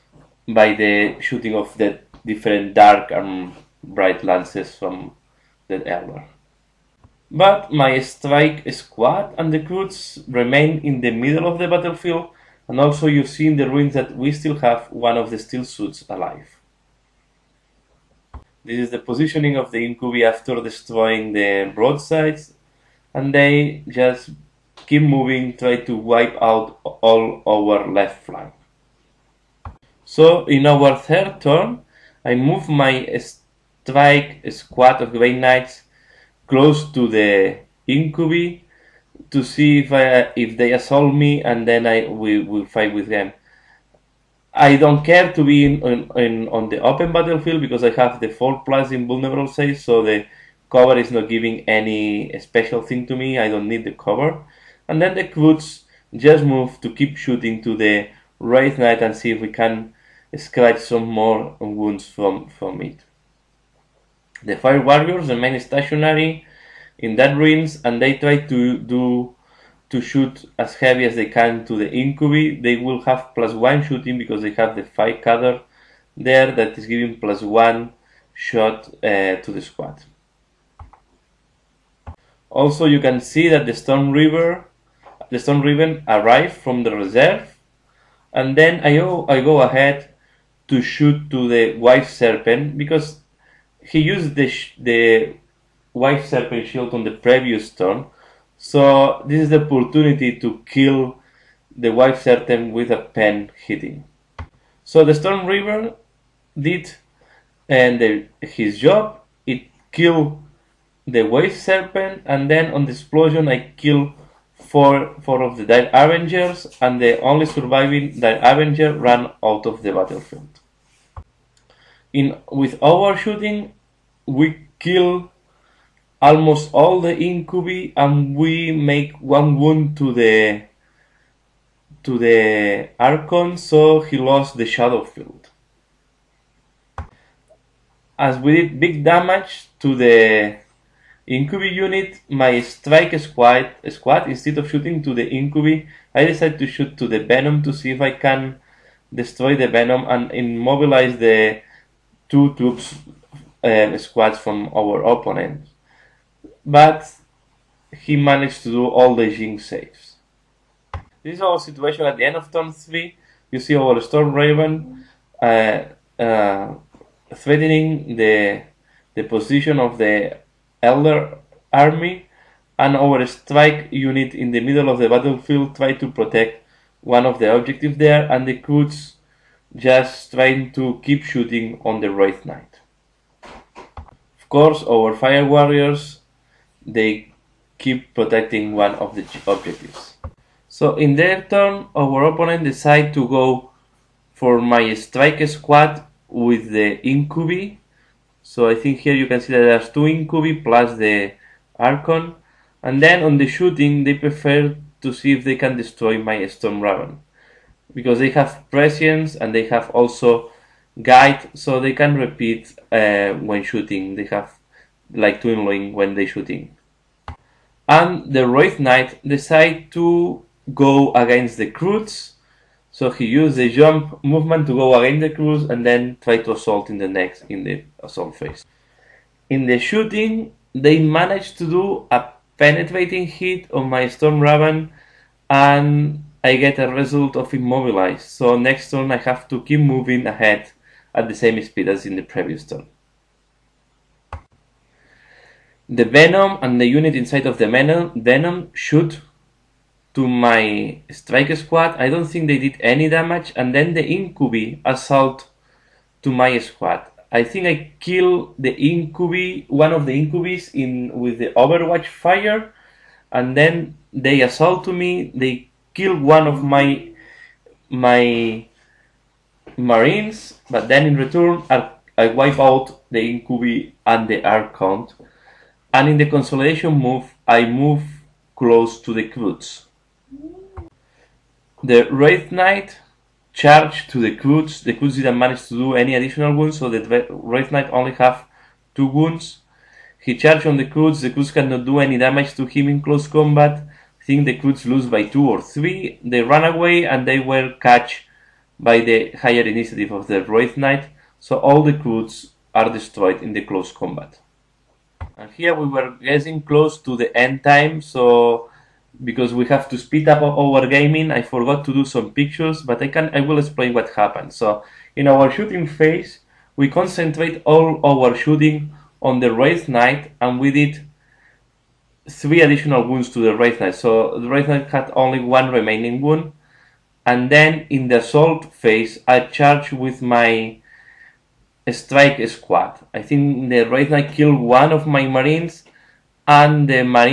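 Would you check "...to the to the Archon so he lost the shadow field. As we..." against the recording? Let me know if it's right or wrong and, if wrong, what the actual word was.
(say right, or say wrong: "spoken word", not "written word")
right.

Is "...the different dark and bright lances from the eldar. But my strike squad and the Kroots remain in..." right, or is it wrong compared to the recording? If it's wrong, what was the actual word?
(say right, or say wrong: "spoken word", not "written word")
right.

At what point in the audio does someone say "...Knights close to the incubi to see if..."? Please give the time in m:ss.
0:35.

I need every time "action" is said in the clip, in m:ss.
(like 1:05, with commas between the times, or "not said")
not said.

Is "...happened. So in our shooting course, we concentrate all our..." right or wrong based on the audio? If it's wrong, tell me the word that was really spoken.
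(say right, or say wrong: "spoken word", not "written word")
wrong: "phase", not "course".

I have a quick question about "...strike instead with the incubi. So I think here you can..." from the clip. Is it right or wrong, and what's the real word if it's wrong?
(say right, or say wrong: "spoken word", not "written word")
wrong: "squad", not "instead".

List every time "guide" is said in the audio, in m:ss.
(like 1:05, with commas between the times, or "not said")
3:31.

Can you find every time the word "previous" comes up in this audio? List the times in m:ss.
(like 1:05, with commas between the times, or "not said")
1:37, 4:02.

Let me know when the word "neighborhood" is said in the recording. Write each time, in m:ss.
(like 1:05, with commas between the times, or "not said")
not said.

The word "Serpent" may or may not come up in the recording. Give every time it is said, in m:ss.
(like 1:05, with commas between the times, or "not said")
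1:32, 1:36, 1:42, 1:51.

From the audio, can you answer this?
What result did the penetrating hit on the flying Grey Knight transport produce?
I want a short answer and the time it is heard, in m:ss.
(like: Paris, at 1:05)
Immobilized, at 3:57.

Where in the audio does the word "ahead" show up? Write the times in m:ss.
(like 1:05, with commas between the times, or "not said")
1:29, 4:00.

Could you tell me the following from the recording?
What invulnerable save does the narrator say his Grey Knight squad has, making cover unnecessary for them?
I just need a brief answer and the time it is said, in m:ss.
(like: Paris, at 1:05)
4+, at 0:48.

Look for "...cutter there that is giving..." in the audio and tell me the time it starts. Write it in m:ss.
1:15.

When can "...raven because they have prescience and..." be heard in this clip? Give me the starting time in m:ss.
3:26.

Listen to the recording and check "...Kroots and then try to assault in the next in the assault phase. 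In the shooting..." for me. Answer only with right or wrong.
right.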